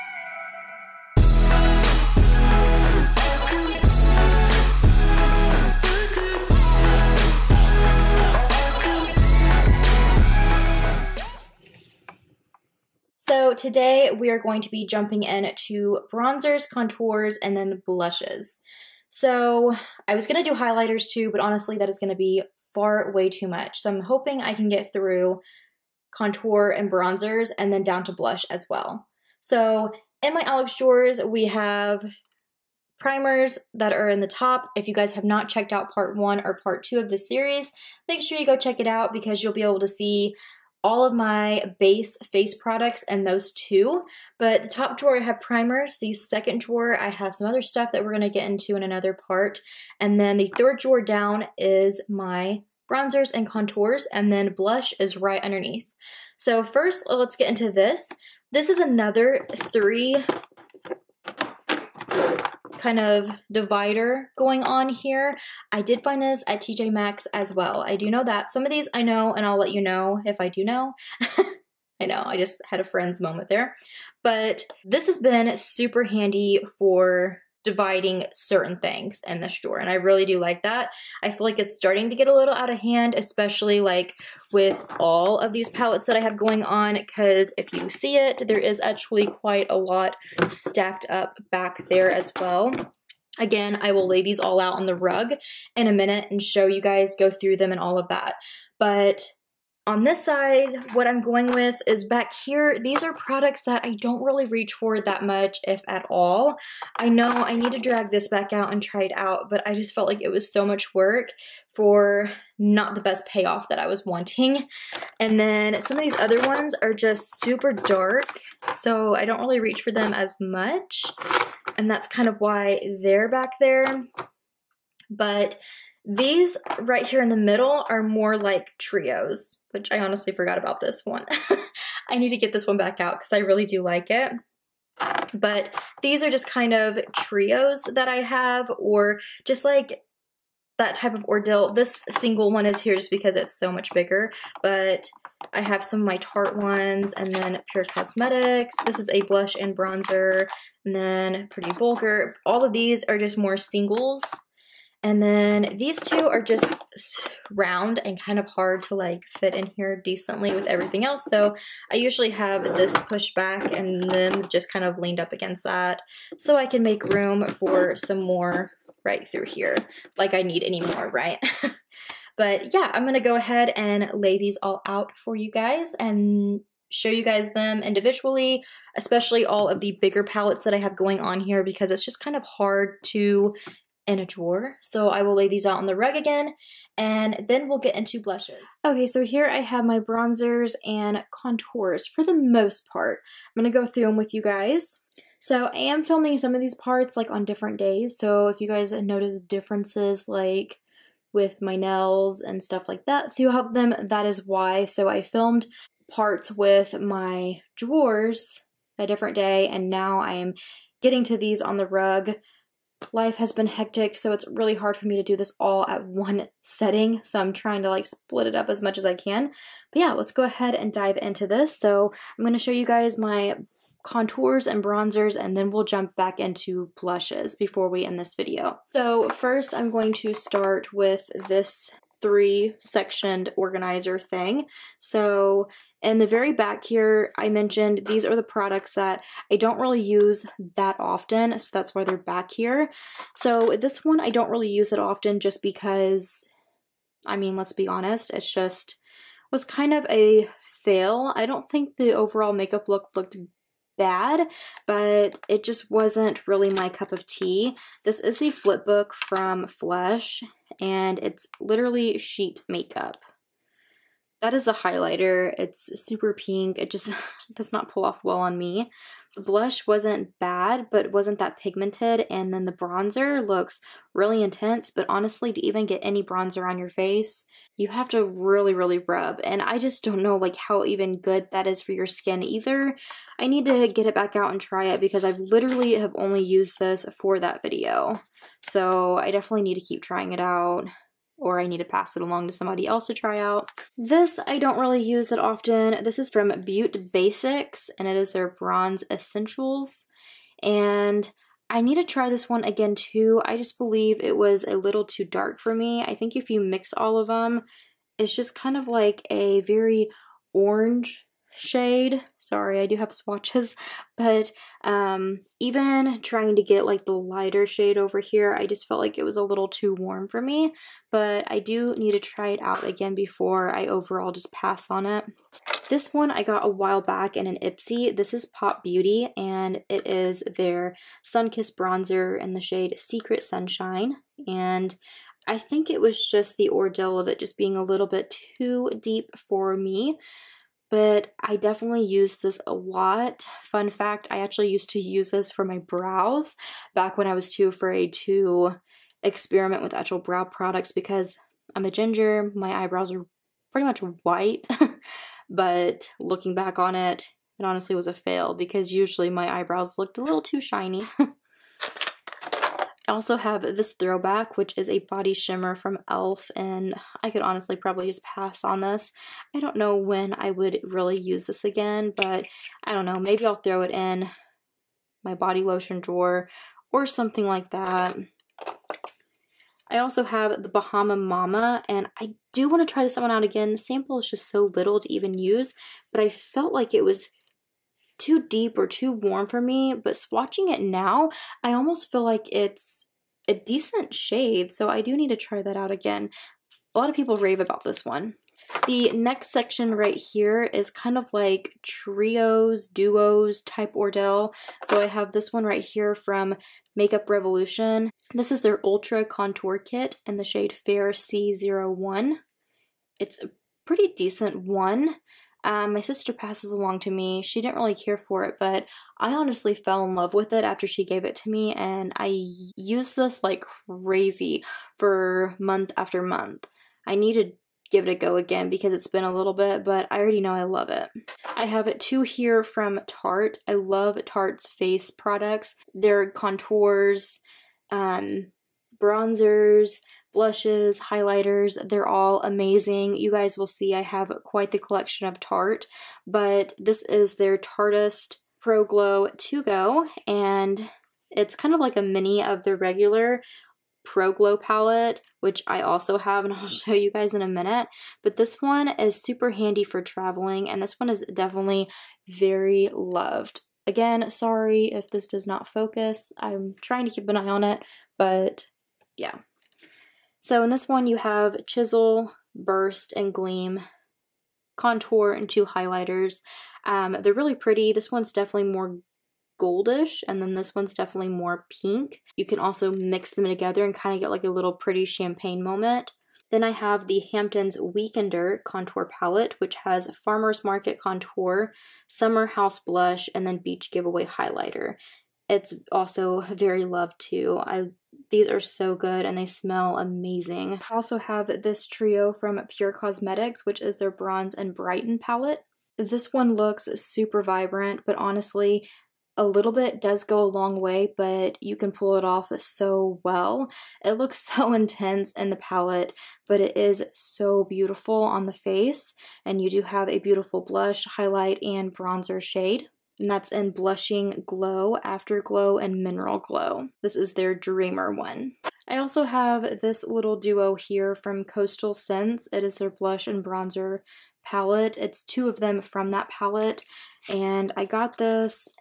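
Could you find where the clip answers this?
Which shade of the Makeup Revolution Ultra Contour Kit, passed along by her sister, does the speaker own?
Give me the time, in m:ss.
6:50.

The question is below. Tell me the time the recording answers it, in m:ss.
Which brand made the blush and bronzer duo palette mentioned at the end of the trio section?
8:51.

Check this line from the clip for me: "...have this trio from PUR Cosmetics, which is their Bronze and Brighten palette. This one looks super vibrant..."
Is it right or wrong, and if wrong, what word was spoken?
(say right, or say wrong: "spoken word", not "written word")
right.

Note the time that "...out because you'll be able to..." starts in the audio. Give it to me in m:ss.
0:38.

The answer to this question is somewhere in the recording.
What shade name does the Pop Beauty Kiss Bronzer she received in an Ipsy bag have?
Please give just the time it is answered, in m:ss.
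5:32.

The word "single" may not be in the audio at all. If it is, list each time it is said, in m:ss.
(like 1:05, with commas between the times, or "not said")
2:22, 2:33.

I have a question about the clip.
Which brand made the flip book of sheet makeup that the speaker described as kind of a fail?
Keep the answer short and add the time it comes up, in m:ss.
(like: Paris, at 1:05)
Flesh, at 4:19.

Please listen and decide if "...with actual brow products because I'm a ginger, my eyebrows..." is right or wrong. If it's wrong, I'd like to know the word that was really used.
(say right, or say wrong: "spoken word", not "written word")
right.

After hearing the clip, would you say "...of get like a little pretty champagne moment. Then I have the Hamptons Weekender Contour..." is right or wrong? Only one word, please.
right.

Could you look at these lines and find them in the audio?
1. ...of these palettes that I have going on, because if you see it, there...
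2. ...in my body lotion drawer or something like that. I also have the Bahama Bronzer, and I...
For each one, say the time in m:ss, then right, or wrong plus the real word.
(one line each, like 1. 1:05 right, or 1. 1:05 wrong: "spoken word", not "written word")
1. 1:25 right
2. 6:13 wrong: "Mama", not "Bronzer".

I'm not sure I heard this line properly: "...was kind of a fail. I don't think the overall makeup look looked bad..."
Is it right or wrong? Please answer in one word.
right.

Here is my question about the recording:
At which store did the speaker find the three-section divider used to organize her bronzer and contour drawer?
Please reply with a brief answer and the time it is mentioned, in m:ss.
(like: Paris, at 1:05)
TJ Maxx, at 1:06.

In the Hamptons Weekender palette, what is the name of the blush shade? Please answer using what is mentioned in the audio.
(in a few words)
Summer House.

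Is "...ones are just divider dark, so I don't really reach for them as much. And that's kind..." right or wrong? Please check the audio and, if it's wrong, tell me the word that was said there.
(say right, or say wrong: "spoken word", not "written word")
wrong: "super", not "divider".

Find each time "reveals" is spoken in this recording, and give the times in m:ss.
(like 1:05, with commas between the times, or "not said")
not said.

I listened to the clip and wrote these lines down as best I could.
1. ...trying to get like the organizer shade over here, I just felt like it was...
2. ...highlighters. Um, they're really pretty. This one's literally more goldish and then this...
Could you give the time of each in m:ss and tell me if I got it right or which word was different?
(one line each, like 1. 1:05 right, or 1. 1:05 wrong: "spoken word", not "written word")
1. 5:16 wrong: "lighter", not "organizer"
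2. 7:55 wrong: "definitely", not "literally".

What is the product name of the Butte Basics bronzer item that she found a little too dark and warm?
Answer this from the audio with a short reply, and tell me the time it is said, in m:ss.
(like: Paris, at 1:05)
Bronze Essentials, at 4:58.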